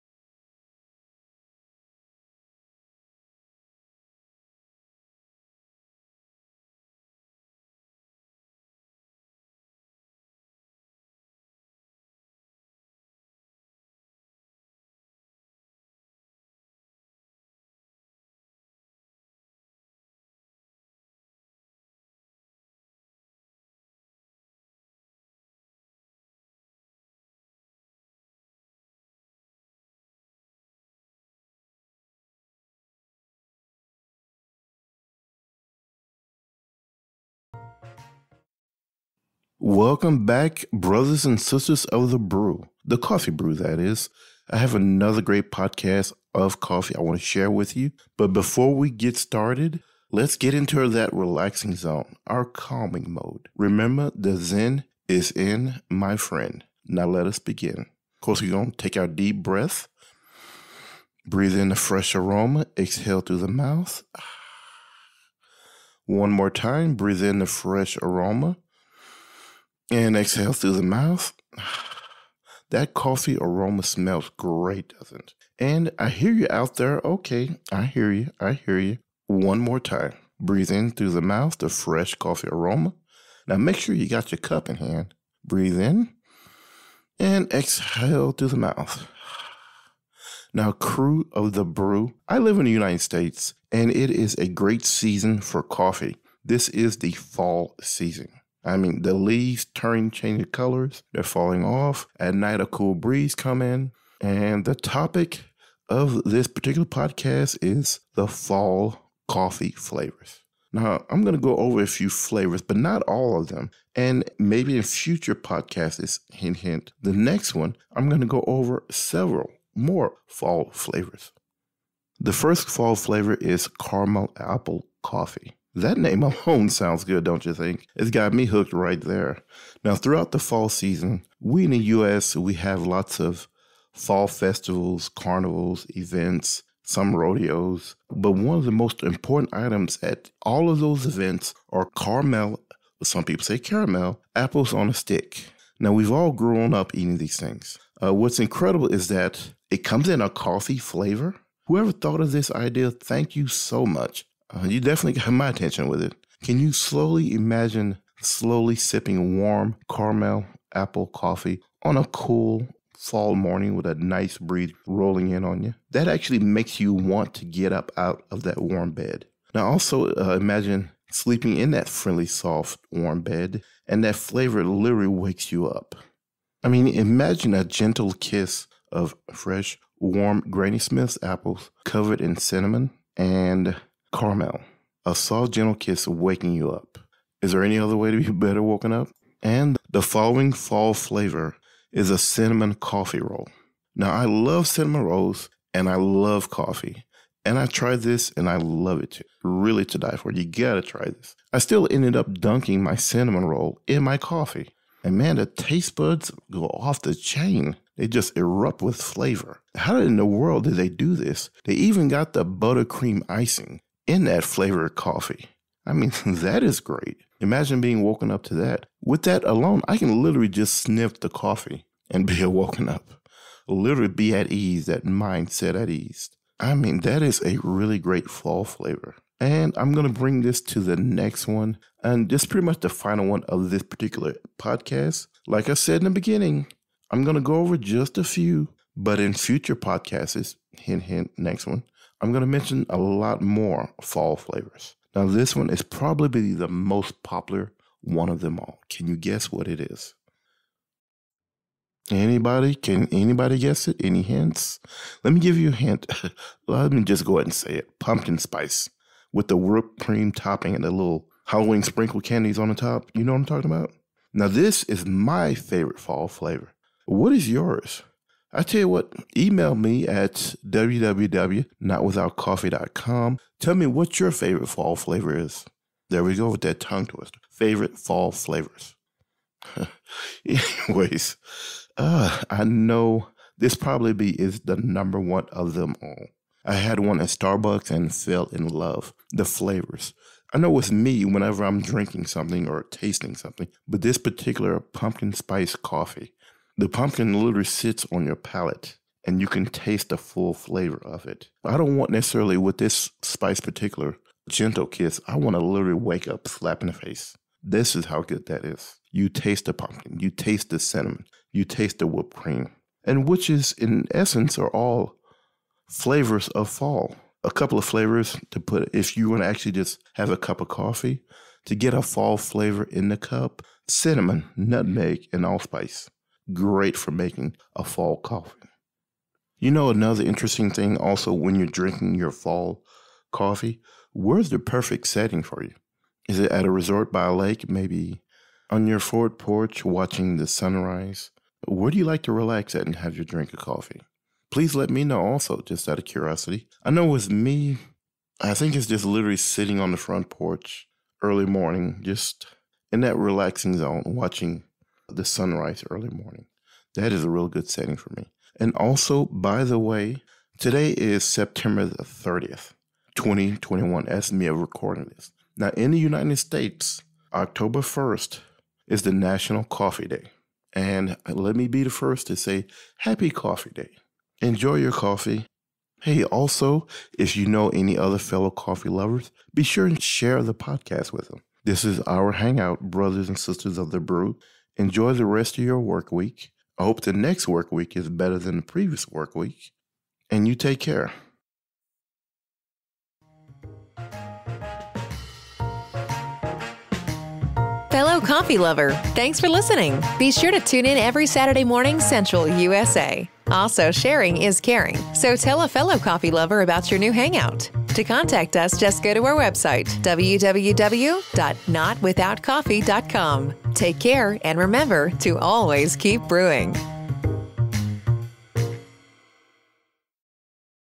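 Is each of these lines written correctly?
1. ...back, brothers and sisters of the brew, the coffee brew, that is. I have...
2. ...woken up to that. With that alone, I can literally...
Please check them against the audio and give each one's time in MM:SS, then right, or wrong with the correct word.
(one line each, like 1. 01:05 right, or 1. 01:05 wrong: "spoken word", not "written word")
1. 00:40 right
2. 03:38 right.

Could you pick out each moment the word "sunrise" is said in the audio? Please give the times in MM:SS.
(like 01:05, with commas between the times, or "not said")
05:40, 05:55.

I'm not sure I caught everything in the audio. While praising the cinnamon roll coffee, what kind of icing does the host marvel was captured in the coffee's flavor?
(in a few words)
buttercream icing.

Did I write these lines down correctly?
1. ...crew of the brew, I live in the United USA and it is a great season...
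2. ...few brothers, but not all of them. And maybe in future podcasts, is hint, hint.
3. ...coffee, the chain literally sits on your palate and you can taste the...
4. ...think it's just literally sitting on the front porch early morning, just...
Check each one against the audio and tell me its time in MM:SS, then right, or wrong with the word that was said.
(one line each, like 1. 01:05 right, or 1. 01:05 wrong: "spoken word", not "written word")
1. 01:30 wrong: "States", not "USA"
2. 01:51 wrong: "flavors", not "brothers"
3. 04:55 wrong: "pumpkin", not "chain"
4. 05:48 right.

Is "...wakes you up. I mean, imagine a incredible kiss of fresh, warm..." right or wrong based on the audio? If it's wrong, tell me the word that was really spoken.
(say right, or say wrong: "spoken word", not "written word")
wrong: "gentle", not "incredible".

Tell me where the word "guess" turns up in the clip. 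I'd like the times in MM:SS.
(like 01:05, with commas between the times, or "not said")
04:09, 04:13.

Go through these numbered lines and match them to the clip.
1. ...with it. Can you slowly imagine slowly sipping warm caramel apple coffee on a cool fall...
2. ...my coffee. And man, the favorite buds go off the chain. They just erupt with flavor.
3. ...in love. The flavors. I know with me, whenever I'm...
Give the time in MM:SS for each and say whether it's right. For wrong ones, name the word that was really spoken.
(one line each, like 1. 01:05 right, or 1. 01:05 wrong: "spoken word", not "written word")
1. 02:35 right
2. 03:24 wrong: "taste", not "favorite"
3. 04:48 right.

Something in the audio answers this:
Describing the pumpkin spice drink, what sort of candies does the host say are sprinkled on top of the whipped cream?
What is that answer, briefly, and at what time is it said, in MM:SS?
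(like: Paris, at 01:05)
Halloween sprinkle candies, at 04:21.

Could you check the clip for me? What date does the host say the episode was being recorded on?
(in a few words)
September 30, 2021.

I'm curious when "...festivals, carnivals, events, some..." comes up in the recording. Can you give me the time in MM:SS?
02:14.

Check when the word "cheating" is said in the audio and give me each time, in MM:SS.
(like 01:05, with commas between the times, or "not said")
not said.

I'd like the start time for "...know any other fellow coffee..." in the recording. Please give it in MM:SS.
06:17.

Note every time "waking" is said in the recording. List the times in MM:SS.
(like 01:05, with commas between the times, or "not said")
03:06.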